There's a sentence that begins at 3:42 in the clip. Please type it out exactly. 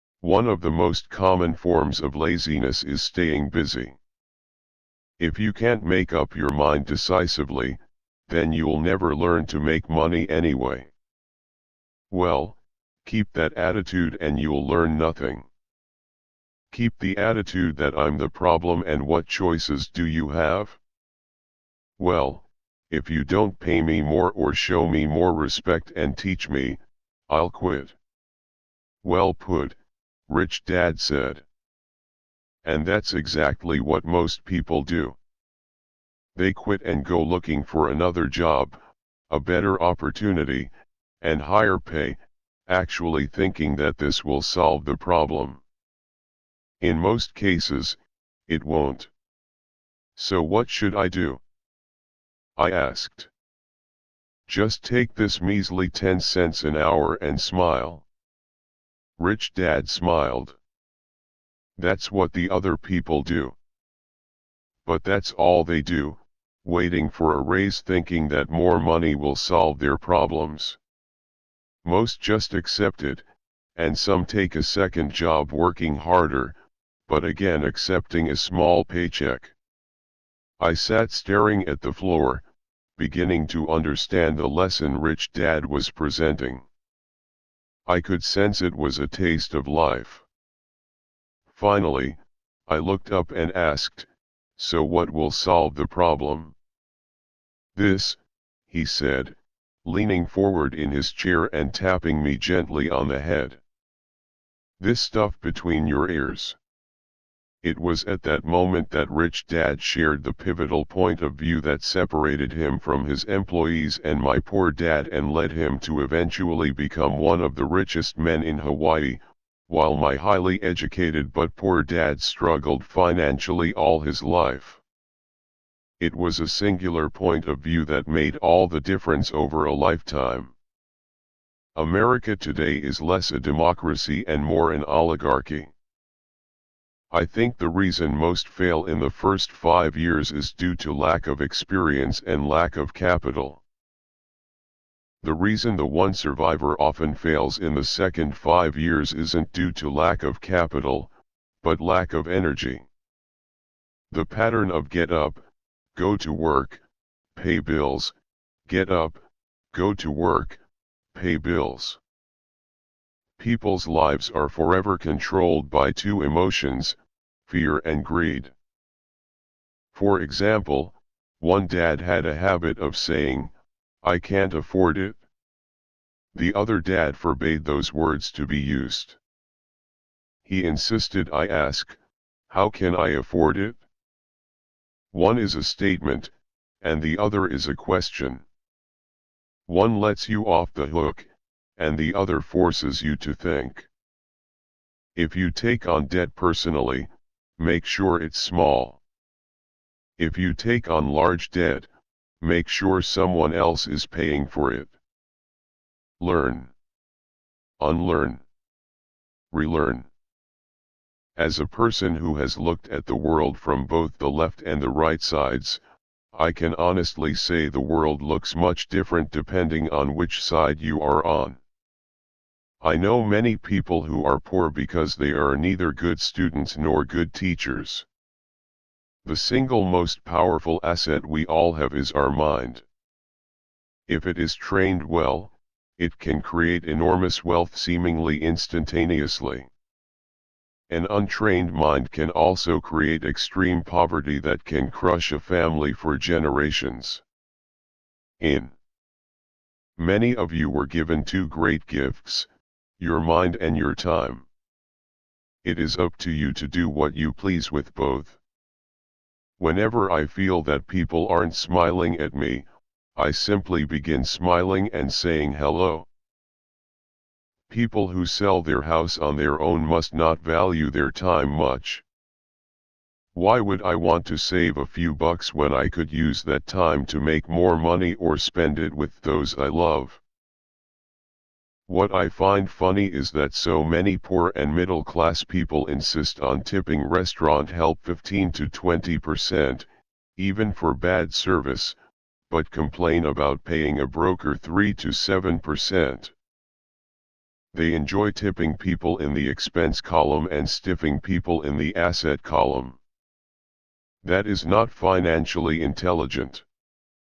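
I know many people who are poor because they are neither good students nor good teachers.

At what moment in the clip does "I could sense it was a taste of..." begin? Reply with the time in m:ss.
1:27.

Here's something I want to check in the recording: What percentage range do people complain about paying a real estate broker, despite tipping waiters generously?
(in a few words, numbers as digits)
3 to 7%.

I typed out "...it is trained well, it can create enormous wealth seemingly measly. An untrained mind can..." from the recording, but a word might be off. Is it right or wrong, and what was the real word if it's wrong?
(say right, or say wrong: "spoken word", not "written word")
wrong: "instantaneously", not "measly".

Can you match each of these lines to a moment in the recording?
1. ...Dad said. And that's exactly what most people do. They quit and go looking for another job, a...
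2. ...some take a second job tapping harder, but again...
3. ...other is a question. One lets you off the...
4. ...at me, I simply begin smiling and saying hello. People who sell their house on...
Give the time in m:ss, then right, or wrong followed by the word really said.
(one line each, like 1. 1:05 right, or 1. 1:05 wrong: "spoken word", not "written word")
1. 0:30 right
2. 1:13 wrong: "working", not "tapping"
3. 3:07 right
4. 4:22 right.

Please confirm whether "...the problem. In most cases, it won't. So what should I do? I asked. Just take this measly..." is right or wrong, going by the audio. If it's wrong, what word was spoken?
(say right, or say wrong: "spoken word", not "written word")
right.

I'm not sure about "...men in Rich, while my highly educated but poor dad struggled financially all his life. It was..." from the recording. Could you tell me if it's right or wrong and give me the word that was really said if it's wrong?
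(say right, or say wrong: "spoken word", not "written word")
wrong: "Hawaii", not "Rich".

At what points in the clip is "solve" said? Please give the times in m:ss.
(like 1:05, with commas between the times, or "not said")
0:44, 1:09, 1:35.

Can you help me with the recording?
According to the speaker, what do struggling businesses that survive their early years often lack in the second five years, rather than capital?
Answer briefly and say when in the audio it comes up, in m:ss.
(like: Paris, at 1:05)
Energy, at 2:32.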